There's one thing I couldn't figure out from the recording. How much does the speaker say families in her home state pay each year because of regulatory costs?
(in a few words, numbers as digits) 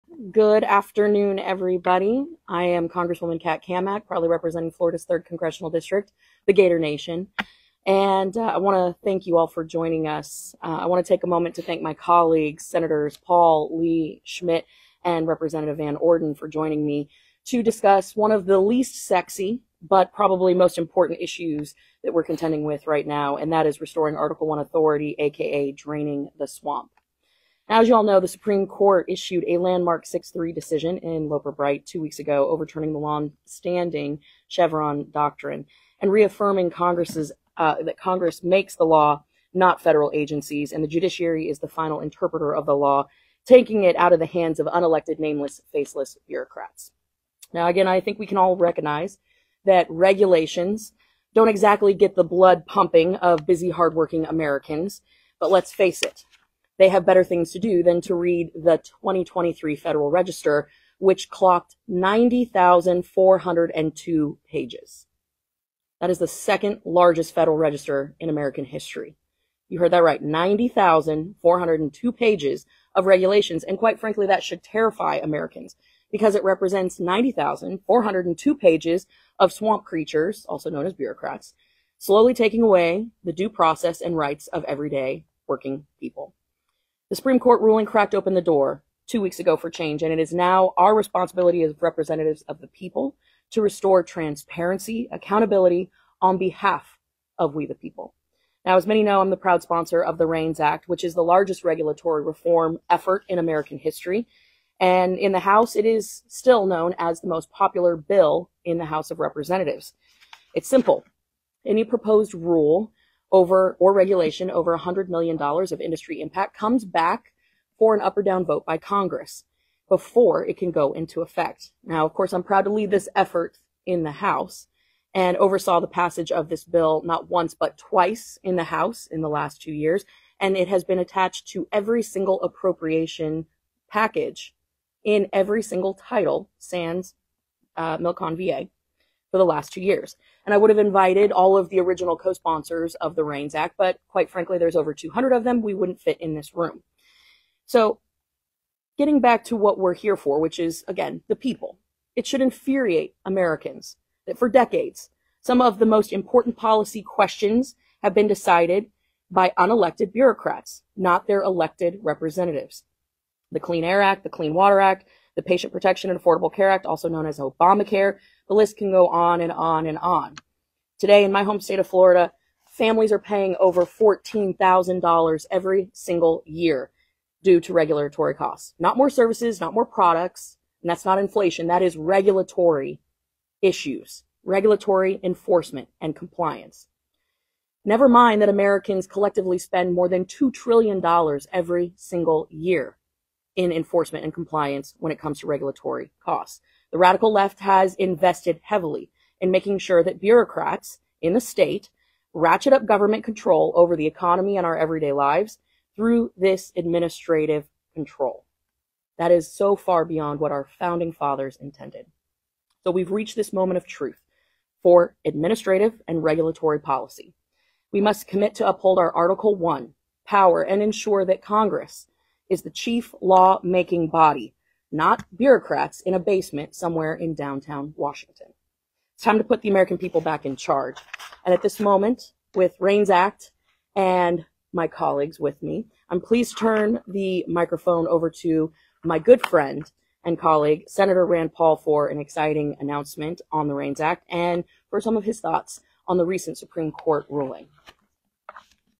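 $14,000.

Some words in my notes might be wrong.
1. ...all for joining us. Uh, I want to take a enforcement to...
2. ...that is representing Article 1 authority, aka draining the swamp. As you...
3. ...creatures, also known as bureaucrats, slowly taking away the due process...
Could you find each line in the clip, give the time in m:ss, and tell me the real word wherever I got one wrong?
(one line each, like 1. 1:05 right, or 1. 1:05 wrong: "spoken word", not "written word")
1. 0:09 wrong: "moment", not "enforcement"
2. 0:23 wrong: "restoring", not "representing"
3. 1:19 right.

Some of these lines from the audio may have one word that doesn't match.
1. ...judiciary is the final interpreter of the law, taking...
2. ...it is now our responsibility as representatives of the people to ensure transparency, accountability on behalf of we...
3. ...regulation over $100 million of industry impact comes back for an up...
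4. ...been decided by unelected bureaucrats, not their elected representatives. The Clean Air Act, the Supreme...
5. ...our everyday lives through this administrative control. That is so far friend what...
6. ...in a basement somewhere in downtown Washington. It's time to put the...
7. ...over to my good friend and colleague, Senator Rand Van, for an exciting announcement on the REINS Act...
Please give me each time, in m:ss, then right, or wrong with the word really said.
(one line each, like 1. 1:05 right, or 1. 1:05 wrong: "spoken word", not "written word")
1. 0:40 right
2. 1:30 wrong: "restore", not "ensure"
3. 1:53 right
4. 2:38 wrong: "Clean", not "Supreme"
5. 3:24 wrong: "beyond", not "friend"
6. 3:46 right
7. 3:58 wrong: "Paul", not "Van".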